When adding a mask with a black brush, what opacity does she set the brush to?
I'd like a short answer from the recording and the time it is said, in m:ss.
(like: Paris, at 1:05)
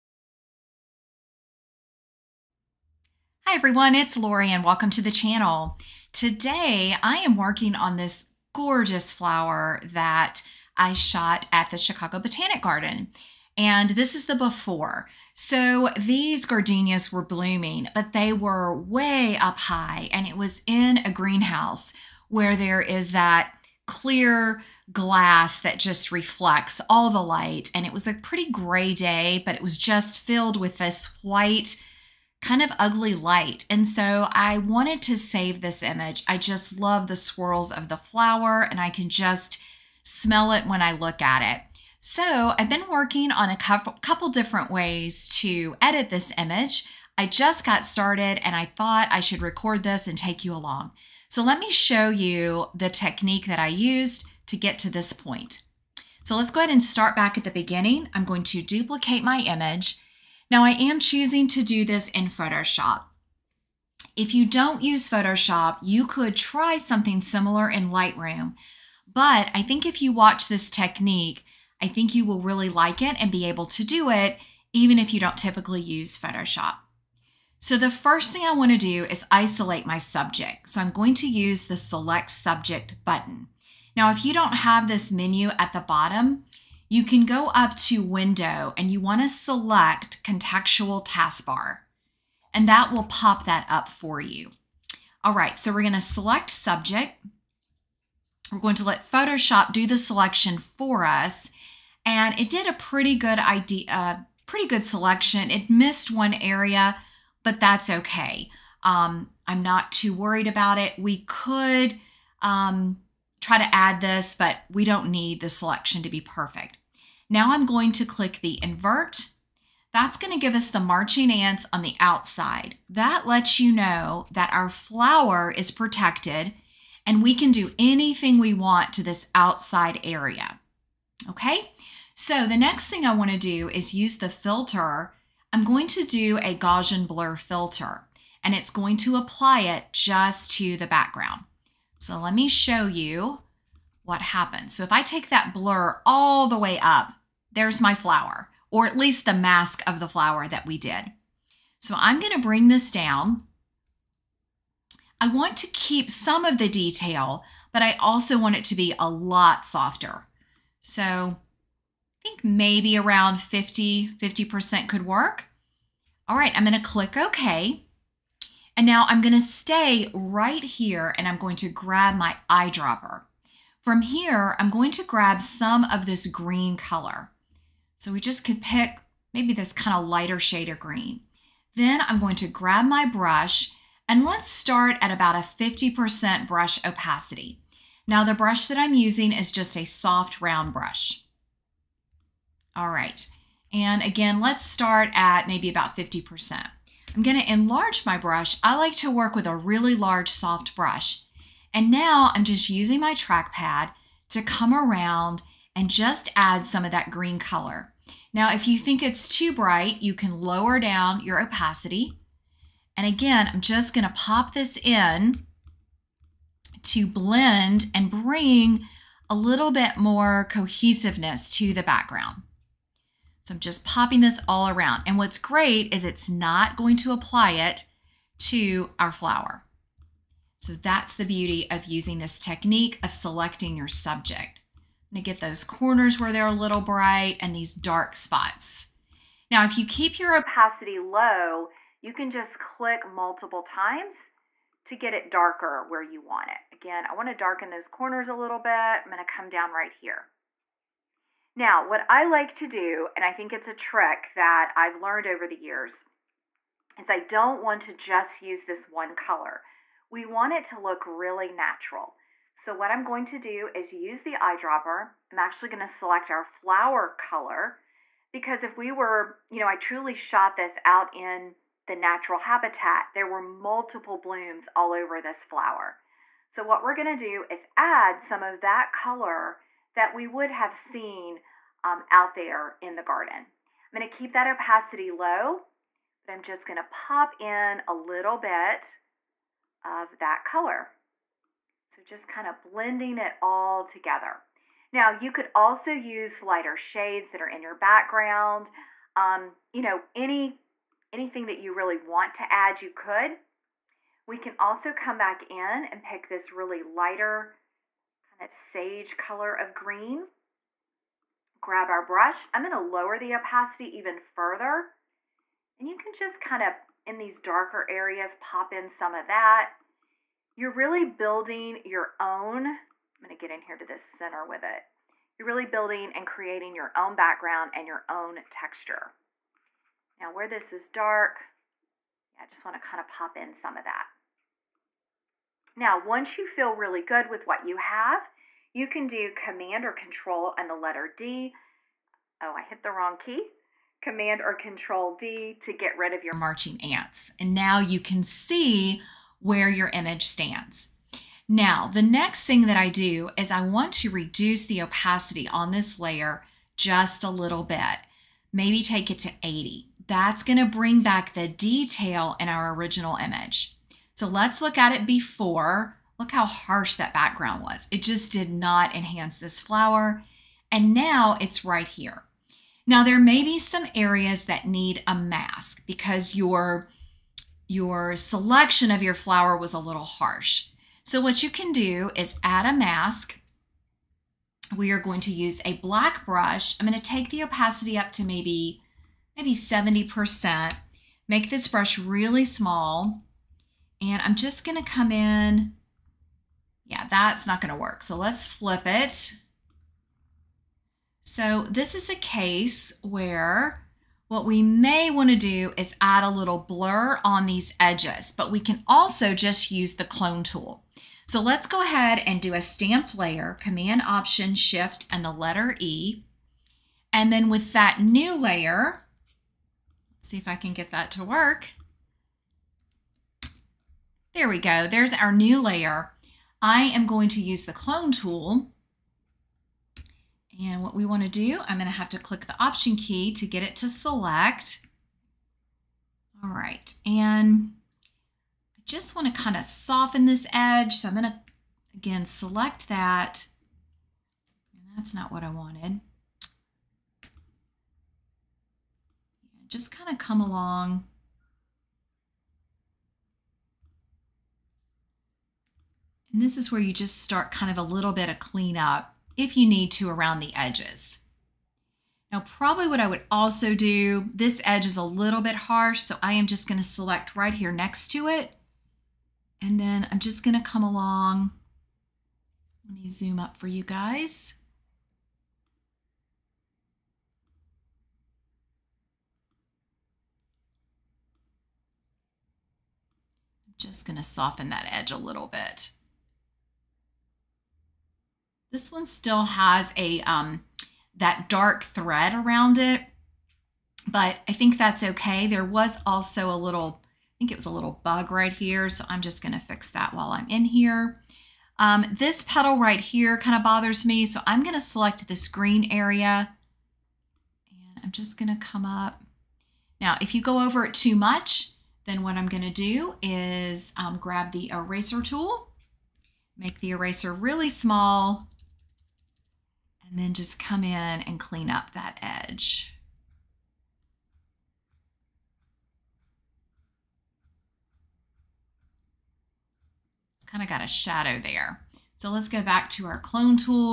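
70%, at 6:29.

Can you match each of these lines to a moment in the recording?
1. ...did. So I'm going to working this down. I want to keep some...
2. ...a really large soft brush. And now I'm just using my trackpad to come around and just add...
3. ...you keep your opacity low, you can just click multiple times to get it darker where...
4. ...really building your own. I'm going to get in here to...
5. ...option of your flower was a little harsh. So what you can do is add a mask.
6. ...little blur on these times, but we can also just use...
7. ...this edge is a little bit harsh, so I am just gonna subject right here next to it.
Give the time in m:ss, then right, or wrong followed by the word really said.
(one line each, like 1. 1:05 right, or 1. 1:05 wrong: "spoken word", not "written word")
1. 2:30 wrong: "bring", not "working"
2. 3:19 right
3. 3:59 right
4. 5:20 right
5. 6:18 wrong: "selection", not "option"
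6. 6:46 wrong: "edges", not "times"
7. 7:44 wrong: "select", not "subject".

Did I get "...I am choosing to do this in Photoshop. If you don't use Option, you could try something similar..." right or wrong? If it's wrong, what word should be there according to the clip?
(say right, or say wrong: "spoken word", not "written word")
wrong: "Photoshop", not "Option".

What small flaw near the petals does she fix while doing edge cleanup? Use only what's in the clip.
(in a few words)
a little bug.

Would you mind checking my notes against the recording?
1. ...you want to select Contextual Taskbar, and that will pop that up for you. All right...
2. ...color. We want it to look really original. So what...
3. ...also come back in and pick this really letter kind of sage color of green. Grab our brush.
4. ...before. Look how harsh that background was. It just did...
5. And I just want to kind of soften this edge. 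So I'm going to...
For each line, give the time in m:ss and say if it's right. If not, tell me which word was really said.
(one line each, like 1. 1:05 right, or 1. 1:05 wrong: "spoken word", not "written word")
1. 1:28 right
2. 4:19 wrong: "natural", not "original"
3. 5:04 wrong: "lighter", not "letter"
4. 6:05 right
5. 7:17 right.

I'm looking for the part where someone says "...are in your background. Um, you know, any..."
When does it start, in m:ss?
4:57.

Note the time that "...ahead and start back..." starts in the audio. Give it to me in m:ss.
0:56.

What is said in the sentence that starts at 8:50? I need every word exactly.
It's kind of got a shadow there.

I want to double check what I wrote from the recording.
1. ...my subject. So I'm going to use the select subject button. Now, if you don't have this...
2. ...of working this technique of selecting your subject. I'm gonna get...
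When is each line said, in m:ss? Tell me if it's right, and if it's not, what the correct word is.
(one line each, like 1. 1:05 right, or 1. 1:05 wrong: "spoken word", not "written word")
1. 1:19 right
2. 3:51 wrong: "using", not "working".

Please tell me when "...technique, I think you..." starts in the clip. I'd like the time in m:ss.
1:10.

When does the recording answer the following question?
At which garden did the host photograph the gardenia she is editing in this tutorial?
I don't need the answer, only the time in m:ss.
0:11.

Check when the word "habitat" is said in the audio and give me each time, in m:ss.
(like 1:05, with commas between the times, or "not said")
4:32.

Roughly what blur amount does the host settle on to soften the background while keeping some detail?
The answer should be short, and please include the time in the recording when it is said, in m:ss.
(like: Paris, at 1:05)
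50, at 2:43.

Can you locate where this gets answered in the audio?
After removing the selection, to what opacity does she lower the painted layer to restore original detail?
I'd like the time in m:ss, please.
5:59.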